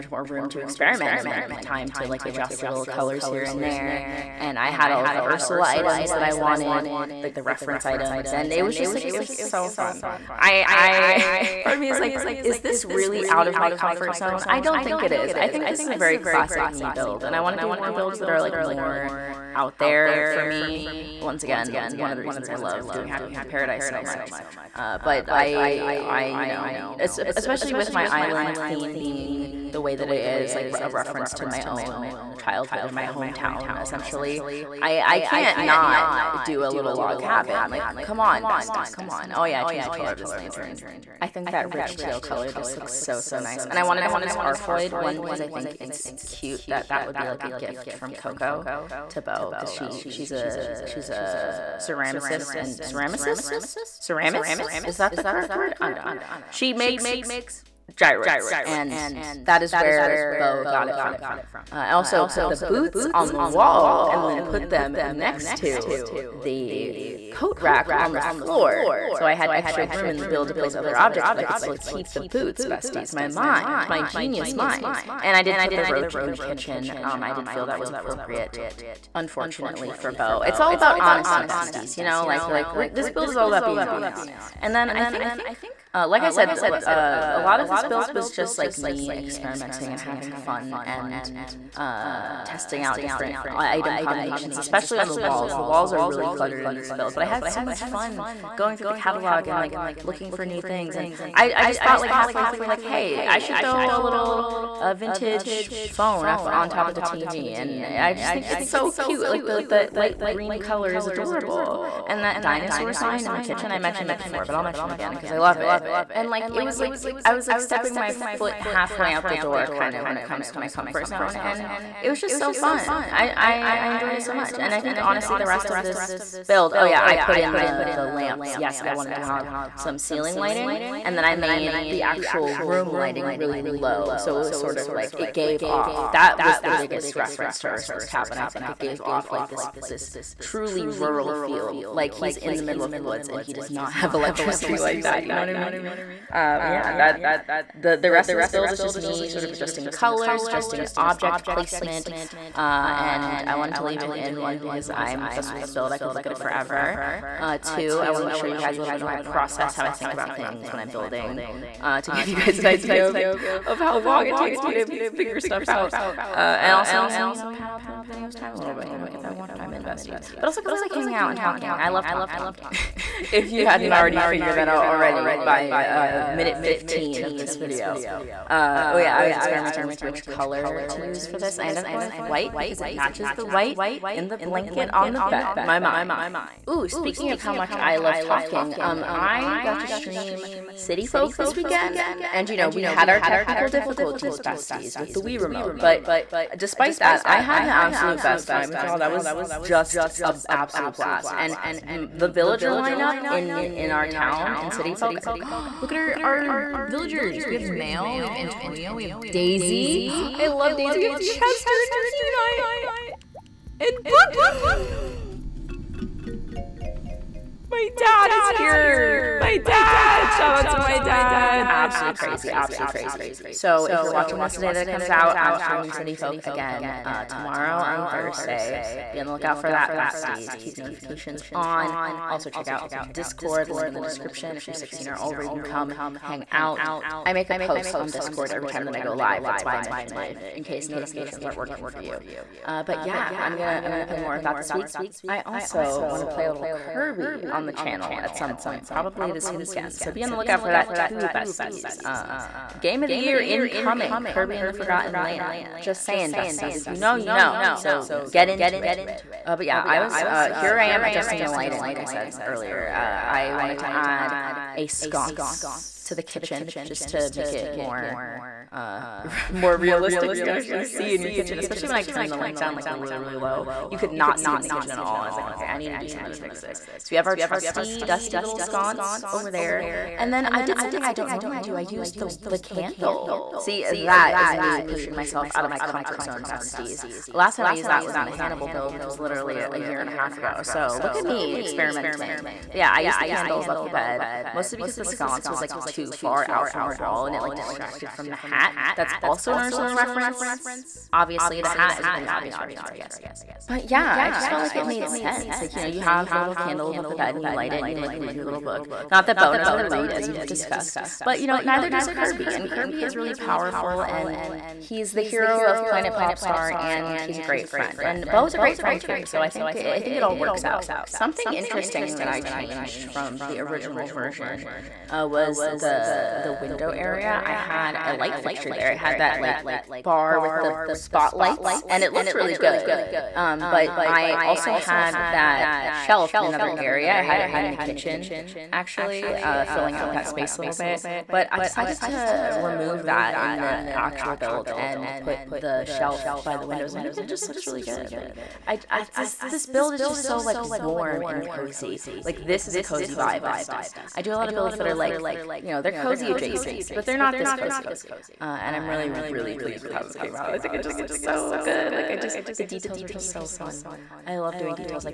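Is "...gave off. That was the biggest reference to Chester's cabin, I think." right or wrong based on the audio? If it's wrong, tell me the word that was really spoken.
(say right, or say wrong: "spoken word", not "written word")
wrong: "Ursula", not "Chester".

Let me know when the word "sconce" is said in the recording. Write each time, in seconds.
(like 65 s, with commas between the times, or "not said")
264 s, 278 s, 295 s.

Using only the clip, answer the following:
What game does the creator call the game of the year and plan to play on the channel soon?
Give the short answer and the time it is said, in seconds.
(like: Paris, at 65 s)
Kirby and the Forgotten Land, at 254 s.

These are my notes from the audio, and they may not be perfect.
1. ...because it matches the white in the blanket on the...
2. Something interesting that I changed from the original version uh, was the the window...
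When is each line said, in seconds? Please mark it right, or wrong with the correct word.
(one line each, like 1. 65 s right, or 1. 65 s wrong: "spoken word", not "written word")
1. 182 s right
2. 321 s right.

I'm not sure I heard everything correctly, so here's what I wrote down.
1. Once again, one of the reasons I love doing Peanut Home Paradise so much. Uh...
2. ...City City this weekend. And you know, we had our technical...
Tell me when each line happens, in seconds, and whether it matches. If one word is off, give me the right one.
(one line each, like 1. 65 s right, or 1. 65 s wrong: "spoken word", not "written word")
1. 21 s wrong: "Happy", not "Peanut"
2. 190 s wrong: "Folk", not "City".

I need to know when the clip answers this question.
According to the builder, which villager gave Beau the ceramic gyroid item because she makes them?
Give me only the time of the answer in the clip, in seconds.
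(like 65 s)
48 s.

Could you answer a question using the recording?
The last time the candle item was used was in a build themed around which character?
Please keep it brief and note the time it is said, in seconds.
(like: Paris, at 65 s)
Hannibal, at 288 s.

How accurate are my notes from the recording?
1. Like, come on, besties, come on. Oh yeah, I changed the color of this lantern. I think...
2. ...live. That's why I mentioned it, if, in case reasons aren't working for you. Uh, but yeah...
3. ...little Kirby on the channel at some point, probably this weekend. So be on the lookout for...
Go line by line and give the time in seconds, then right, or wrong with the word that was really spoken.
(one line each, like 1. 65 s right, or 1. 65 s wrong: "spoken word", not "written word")
1. 37 s right
2. 239 s wrong: "notifications", not "reasons"
3. 246 s right.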